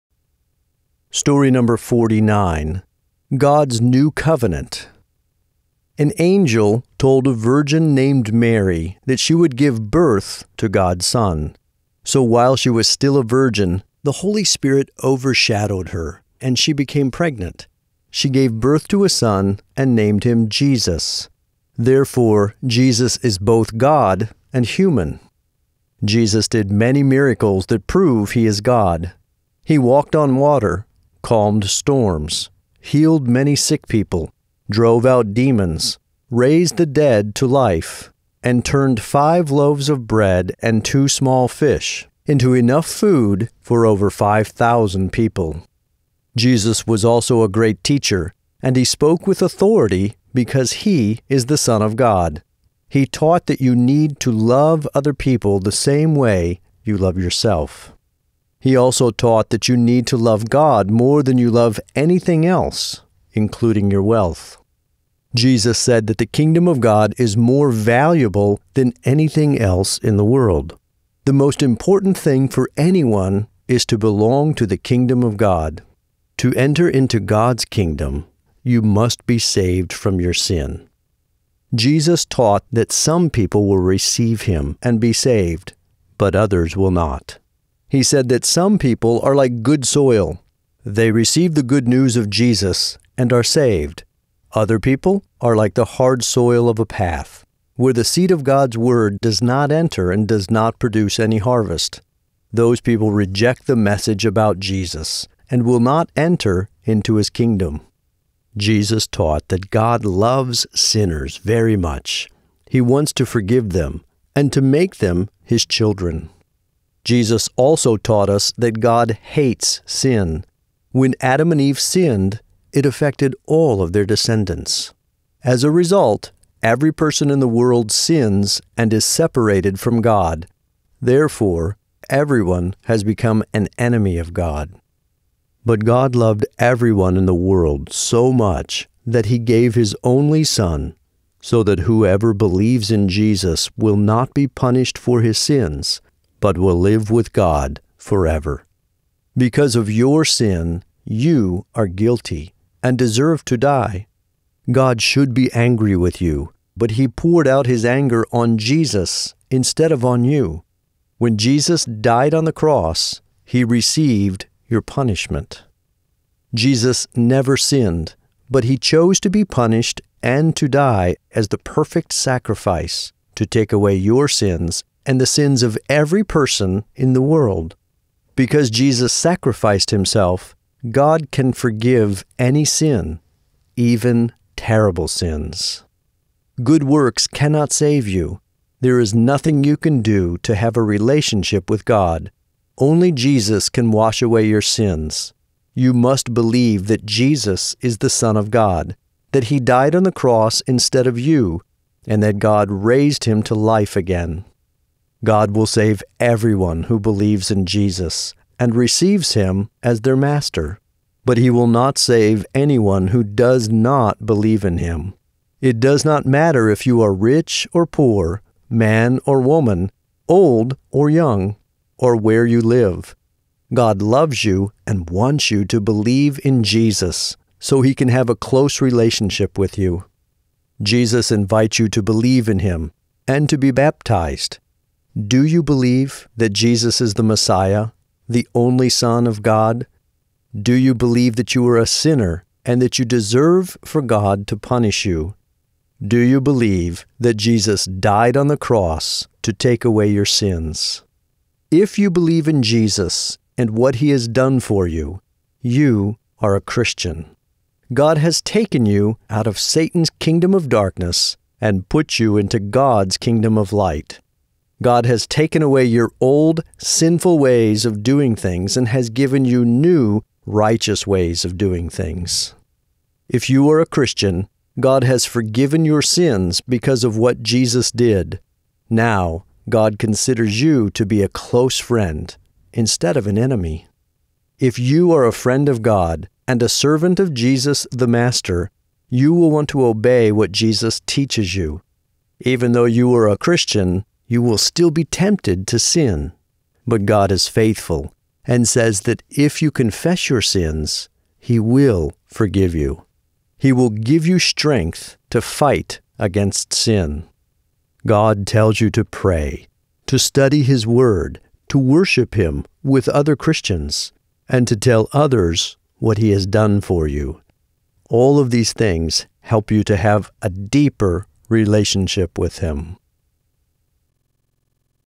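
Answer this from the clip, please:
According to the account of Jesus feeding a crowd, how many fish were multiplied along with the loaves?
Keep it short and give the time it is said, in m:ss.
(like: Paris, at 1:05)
2, at 0:40.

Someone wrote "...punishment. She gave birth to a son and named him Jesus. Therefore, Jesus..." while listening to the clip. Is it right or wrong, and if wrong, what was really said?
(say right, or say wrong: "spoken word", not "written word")
wrong: "pregnant", not "punishment".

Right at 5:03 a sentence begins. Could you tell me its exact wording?
He will give you strength to fight against sin.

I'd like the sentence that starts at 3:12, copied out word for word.
Only Jesus can wash away your sins.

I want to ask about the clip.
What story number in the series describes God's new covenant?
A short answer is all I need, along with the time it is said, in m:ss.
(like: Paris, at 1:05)
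49, at 0:01.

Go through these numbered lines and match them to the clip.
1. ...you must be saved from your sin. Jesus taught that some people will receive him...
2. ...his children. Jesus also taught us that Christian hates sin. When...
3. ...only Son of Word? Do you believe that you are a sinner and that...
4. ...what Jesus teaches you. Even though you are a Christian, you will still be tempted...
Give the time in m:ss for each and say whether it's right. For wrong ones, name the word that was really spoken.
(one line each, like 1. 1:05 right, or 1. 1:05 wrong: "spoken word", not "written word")
1. 1:18 right
2. 1:55 wrong: "God", not "Christian"
3. 3:58 wrong: "God", not "Word"
4. 4:50 right.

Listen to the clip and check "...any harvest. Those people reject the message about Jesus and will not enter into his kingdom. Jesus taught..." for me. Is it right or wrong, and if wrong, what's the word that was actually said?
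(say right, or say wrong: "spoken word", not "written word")
right.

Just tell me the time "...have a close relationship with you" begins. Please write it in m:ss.
3:48.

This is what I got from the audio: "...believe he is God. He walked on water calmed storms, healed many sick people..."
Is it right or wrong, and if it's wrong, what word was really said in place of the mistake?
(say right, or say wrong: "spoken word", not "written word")
wrong: "prove", not "believe".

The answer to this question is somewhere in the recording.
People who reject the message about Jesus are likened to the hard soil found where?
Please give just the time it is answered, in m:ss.
1:36.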